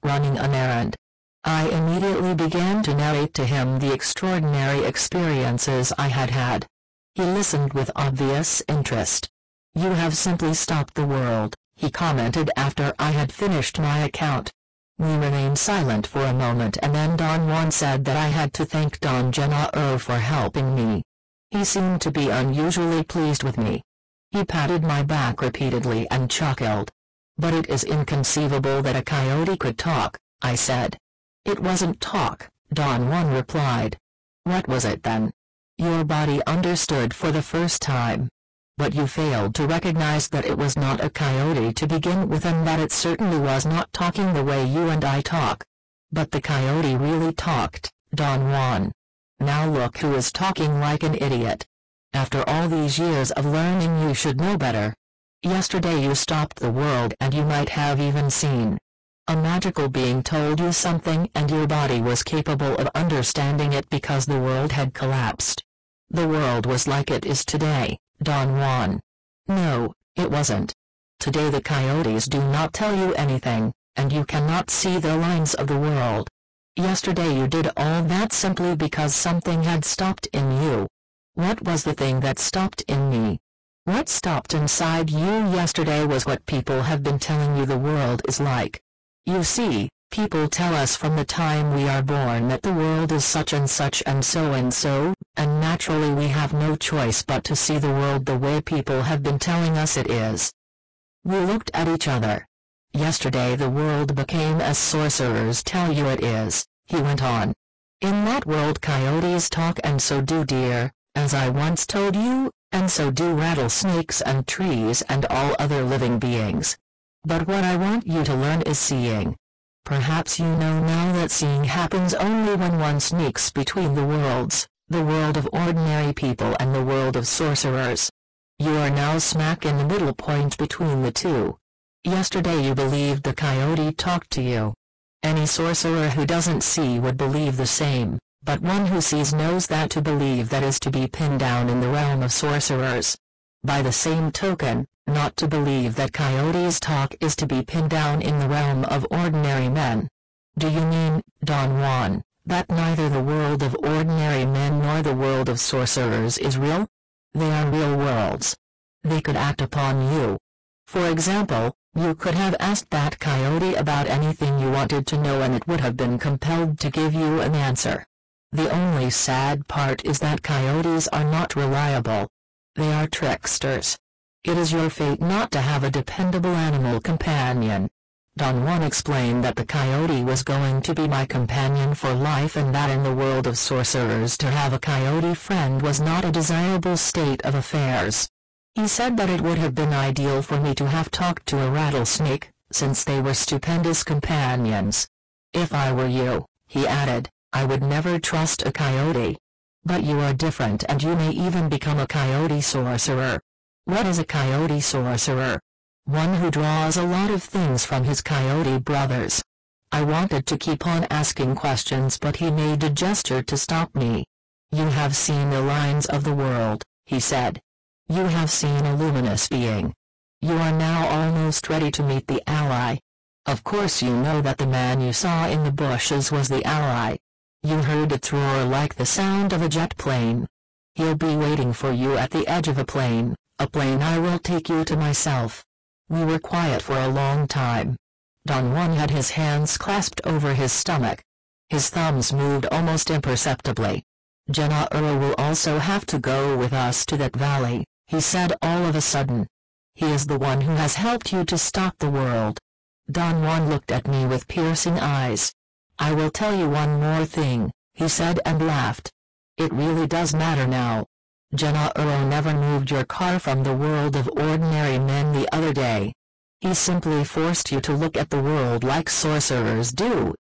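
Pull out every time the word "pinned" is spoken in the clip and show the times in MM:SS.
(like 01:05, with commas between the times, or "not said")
02:21, 02:27.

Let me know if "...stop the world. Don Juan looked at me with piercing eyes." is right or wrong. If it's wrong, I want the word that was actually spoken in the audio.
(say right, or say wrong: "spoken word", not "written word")
right.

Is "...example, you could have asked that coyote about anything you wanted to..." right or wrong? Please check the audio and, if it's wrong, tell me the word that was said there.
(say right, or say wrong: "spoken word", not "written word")
right.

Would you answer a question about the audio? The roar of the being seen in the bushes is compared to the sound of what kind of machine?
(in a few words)
Jet plane.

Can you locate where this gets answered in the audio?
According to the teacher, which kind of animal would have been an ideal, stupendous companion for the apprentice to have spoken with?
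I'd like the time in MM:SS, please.
03:11.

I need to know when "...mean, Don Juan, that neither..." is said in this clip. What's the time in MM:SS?
02:30.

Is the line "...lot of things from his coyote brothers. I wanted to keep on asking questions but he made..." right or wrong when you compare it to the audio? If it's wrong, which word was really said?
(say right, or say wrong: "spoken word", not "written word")
right.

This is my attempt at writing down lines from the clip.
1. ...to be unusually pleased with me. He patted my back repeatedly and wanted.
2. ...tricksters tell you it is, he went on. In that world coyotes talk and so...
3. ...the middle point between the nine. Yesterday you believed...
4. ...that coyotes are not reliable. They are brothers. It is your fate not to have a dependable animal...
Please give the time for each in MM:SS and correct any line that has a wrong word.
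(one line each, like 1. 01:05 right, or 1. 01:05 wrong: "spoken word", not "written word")
1. 00:22 wrong: "chuckled", not "wanted"
2. 01:44 wrong: "sorcerers", not "tricksters"
3. 02:09 wrong: "two", not "nine"
4. 02:50 wrong: "tricksters", not "brothers".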